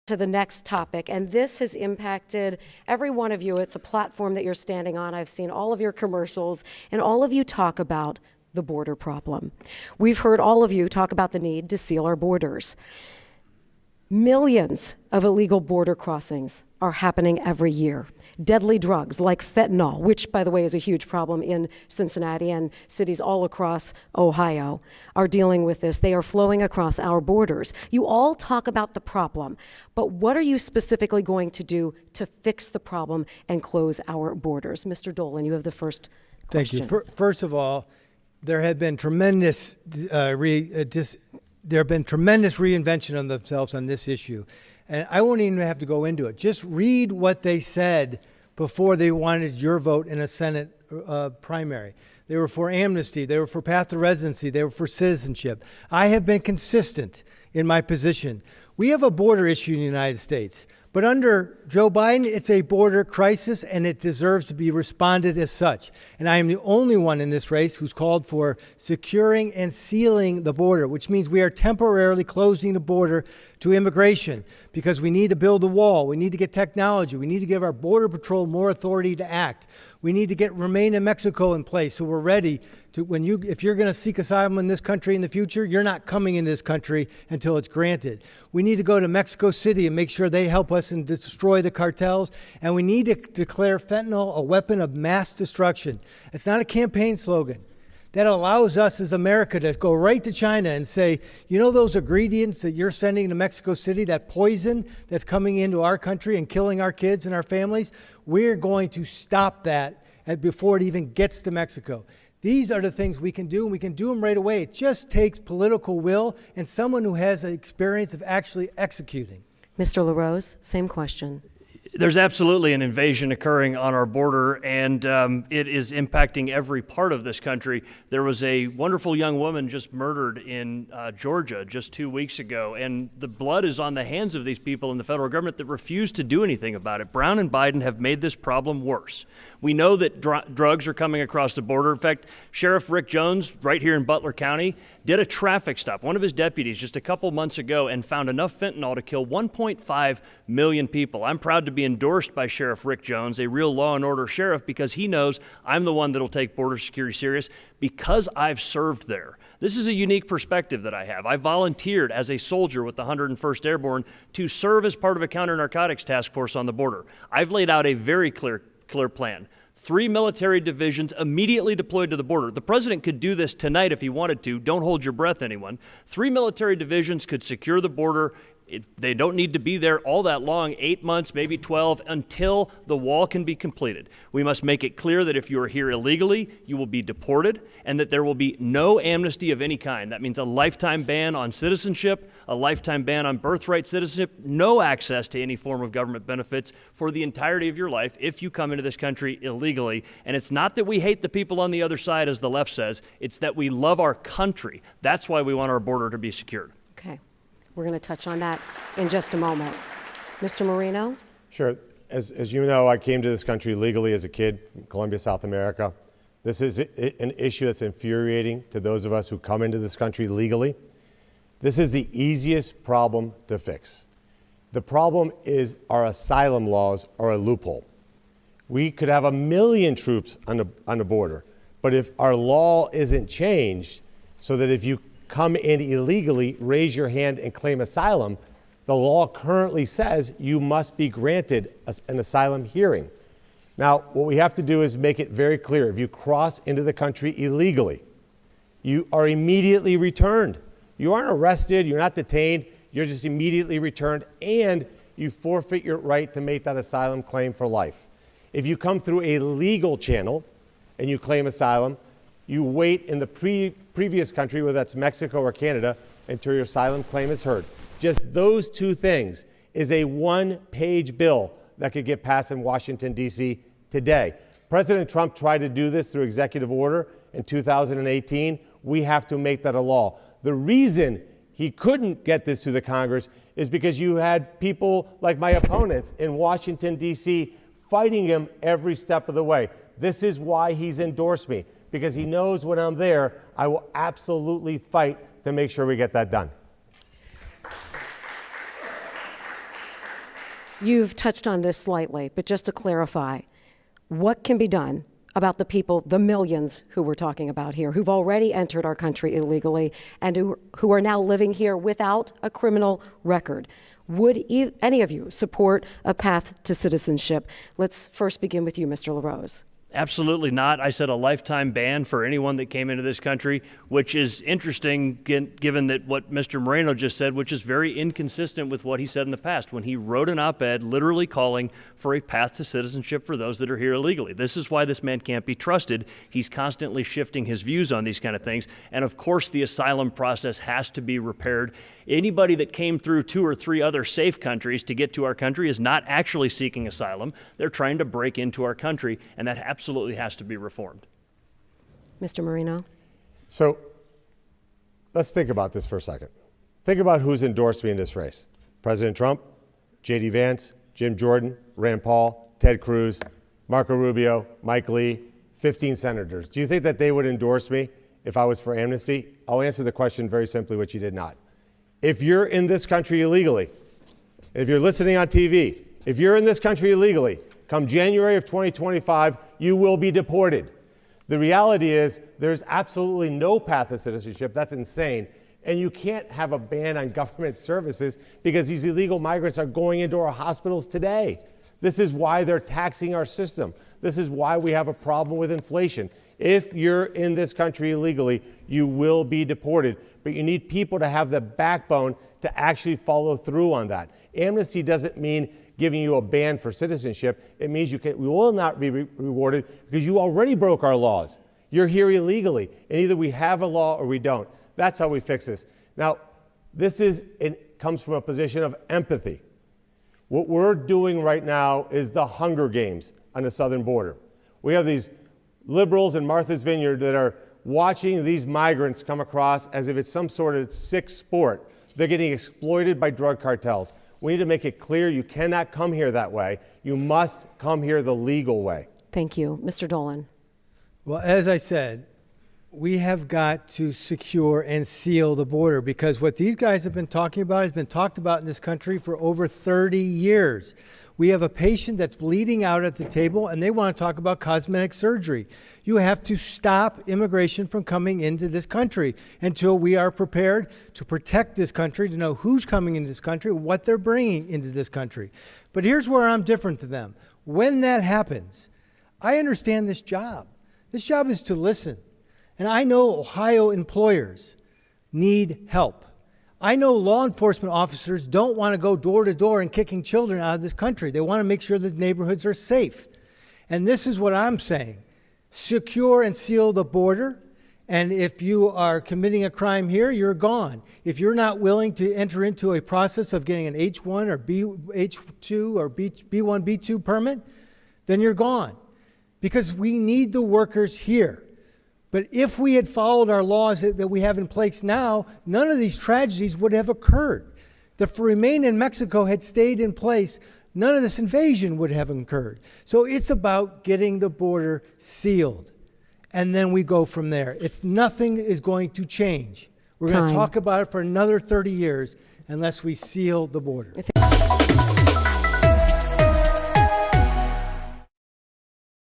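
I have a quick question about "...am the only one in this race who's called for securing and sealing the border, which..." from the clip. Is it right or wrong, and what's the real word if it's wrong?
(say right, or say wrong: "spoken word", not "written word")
right.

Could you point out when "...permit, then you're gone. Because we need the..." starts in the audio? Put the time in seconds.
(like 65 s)
497 s.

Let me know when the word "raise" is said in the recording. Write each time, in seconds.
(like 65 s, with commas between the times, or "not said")
236 s.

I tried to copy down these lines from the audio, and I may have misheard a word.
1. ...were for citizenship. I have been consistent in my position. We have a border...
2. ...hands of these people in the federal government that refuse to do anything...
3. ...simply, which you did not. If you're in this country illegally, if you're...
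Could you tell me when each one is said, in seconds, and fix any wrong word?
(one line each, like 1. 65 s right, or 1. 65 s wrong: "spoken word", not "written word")
1. 54 s right
2. 134 s right
3. 370 s right.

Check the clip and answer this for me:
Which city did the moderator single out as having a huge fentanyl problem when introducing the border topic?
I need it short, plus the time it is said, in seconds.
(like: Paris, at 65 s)
Cincinnati, at 21 s.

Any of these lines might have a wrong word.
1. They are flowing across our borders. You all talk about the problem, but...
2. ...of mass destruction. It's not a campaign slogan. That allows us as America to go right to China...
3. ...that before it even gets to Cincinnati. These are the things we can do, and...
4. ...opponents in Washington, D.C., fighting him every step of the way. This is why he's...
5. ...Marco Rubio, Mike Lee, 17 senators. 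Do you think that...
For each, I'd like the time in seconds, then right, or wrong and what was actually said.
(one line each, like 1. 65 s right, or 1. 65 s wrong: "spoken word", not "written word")
1. 25 s right
2. 94 s right
3. 109 s wrong: "Mexico", not "Cincinnati"
4. 285 s right
5. 363 s wrong: "15", not "17".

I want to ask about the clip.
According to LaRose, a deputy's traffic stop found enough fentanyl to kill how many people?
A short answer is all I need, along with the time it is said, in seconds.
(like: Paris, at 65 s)
1.5 million, at 149 s.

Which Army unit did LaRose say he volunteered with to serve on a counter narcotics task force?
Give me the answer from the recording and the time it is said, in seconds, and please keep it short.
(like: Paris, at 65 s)
101st Airborne, at 163 s.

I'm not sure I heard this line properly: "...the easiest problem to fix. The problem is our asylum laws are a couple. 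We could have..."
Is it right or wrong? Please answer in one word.
wrong.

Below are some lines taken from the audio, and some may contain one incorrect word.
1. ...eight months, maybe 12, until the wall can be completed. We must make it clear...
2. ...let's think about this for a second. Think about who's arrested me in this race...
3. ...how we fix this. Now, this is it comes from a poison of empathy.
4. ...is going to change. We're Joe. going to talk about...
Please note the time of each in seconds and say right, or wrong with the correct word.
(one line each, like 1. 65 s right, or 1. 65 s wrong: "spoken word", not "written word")
1. 180 s right
2. 355 s wrong: "endorsed", not "arrested"
3. 414 s wrong: "position", not "poison"
4. 518 s wrong: "Time", not "Joe".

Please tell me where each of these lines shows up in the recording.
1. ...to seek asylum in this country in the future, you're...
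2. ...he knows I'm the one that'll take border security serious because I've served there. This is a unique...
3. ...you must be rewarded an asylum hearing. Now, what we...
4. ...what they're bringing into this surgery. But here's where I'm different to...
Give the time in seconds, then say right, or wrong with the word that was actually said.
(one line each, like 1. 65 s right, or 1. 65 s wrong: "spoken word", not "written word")
1. 83 s right
2. 154 s right
3. 240 s wrong: "granted", not "rewarded"
4. 463 s wrong: "country", not "surgery".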